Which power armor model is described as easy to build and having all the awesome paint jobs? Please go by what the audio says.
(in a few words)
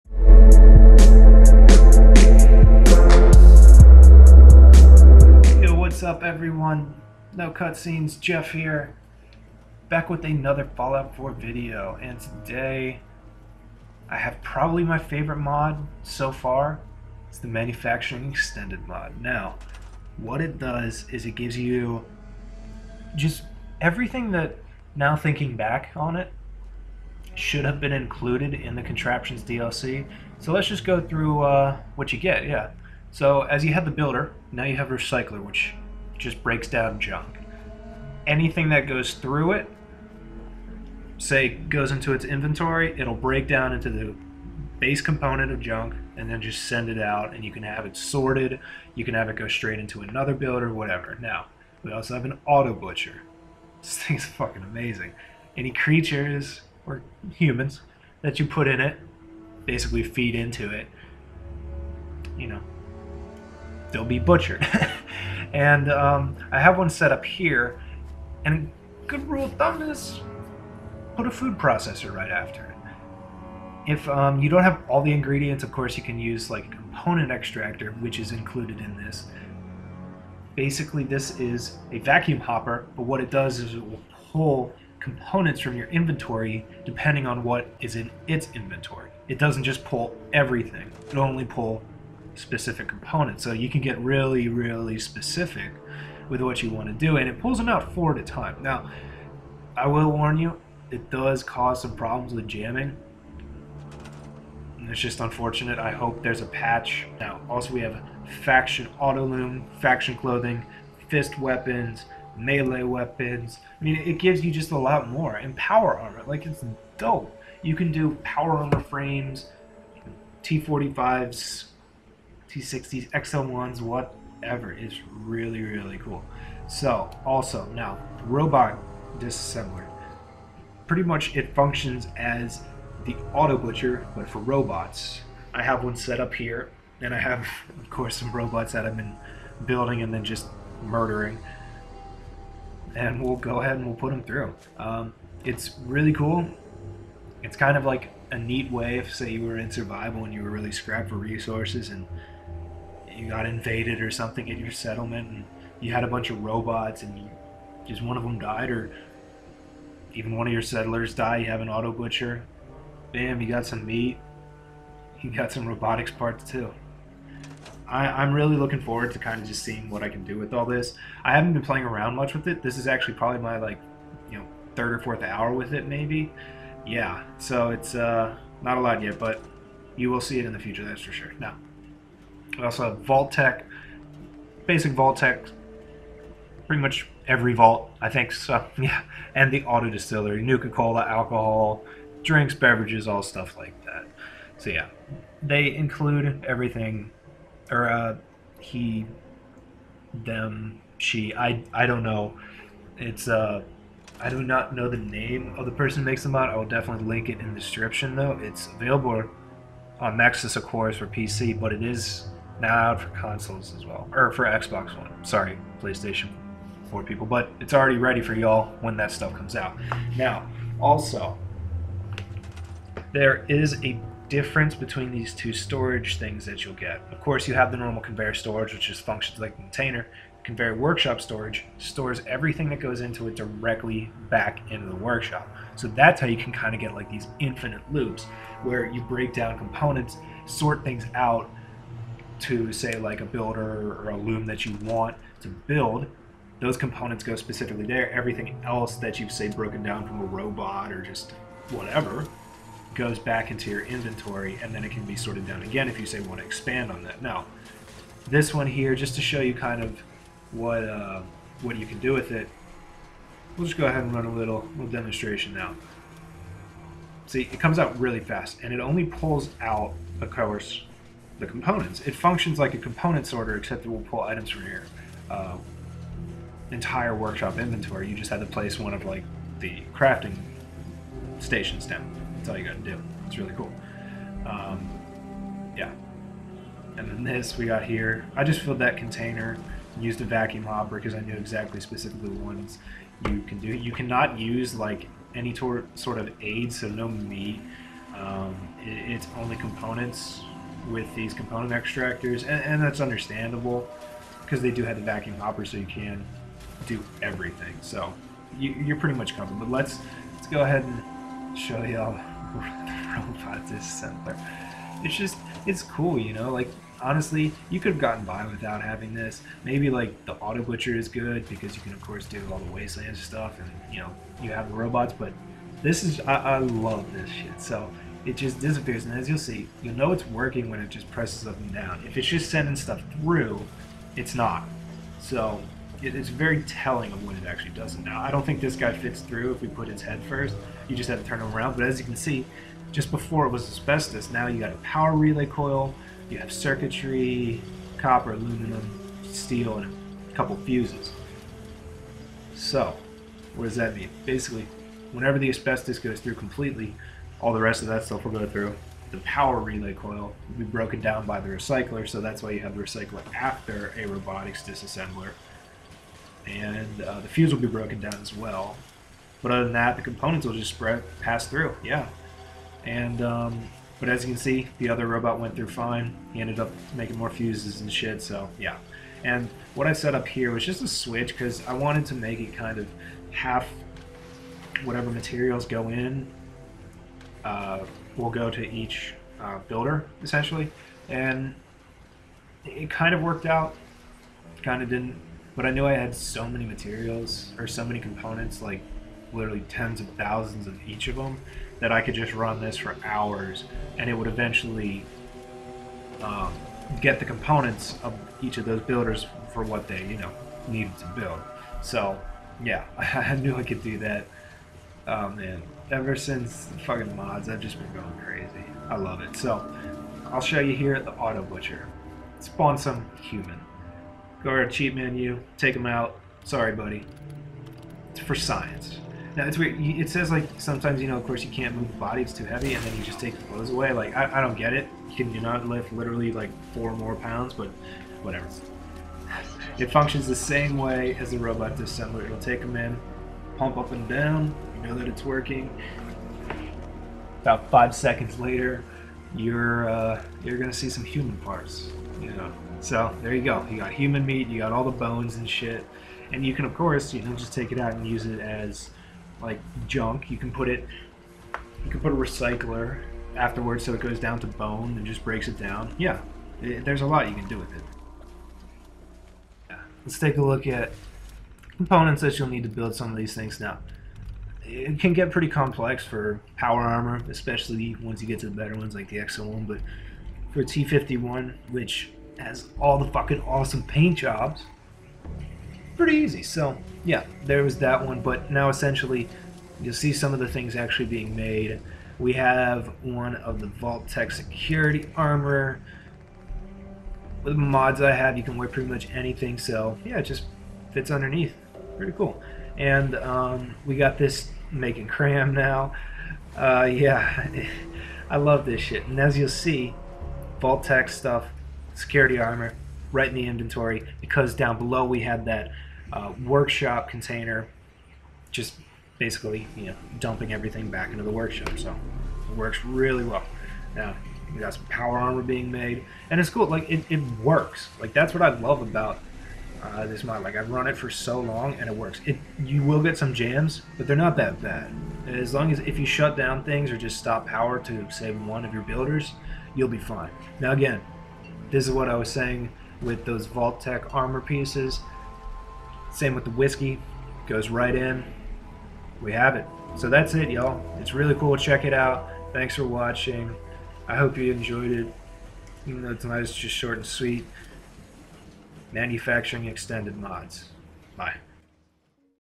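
T51.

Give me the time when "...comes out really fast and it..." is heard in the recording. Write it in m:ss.
4:27.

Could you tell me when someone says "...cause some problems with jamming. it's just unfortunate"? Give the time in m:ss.
1:41.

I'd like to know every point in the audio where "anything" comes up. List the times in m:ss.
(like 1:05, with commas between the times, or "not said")
0:38, 8:19.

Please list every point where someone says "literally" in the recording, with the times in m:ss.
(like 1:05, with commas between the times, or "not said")
6:39, 7:15.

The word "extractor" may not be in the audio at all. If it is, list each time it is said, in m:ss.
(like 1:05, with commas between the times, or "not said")
1:17, 5:01.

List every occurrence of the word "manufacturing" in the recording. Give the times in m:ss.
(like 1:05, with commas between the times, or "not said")
0:17, 9:18.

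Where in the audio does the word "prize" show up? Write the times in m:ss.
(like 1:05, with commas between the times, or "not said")
not said.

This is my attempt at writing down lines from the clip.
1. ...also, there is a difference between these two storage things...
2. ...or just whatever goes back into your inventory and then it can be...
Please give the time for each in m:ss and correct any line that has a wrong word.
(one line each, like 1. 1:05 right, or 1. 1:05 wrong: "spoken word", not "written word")
1. 3:40 right
2. 4:10 right.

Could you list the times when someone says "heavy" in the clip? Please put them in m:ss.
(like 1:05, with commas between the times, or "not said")
7:12.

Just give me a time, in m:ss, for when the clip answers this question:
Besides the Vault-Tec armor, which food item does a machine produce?
8:25.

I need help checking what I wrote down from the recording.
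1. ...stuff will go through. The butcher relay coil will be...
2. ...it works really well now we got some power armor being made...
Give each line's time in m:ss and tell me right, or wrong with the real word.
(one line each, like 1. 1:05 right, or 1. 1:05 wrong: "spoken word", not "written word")
1. 5:58 wrong: "power", not "butcher"
2. 8:42 right.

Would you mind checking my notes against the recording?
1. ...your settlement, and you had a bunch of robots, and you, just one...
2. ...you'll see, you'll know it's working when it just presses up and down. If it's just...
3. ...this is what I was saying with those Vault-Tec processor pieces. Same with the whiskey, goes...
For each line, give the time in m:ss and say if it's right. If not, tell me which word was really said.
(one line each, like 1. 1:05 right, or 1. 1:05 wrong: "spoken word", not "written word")
1. 2:34 right
2. 5:29 right
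3. 9:01 wrong: "armor", not "processor".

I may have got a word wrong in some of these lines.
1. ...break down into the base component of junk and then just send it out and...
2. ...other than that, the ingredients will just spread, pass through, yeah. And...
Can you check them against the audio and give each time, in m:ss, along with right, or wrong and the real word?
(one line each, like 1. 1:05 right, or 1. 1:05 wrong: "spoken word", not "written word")
1. 0:43 right
2. 6:09 wrong: "components", not "ingredients".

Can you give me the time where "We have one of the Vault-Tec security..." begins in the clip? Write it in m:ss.
8:12.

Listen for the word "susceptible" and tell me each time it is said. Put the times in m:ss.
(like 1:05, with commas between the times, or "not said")
not said.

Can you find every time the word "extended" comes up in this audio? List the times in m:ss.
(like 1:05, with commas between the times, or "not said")
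0:18, 9:19.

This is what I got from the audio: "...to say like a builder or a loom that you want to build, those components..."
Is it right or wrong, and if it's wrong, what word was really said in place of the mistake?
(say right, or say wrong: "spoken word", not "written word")
right.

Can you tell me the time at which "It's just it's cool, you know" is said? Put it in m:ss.
5:15.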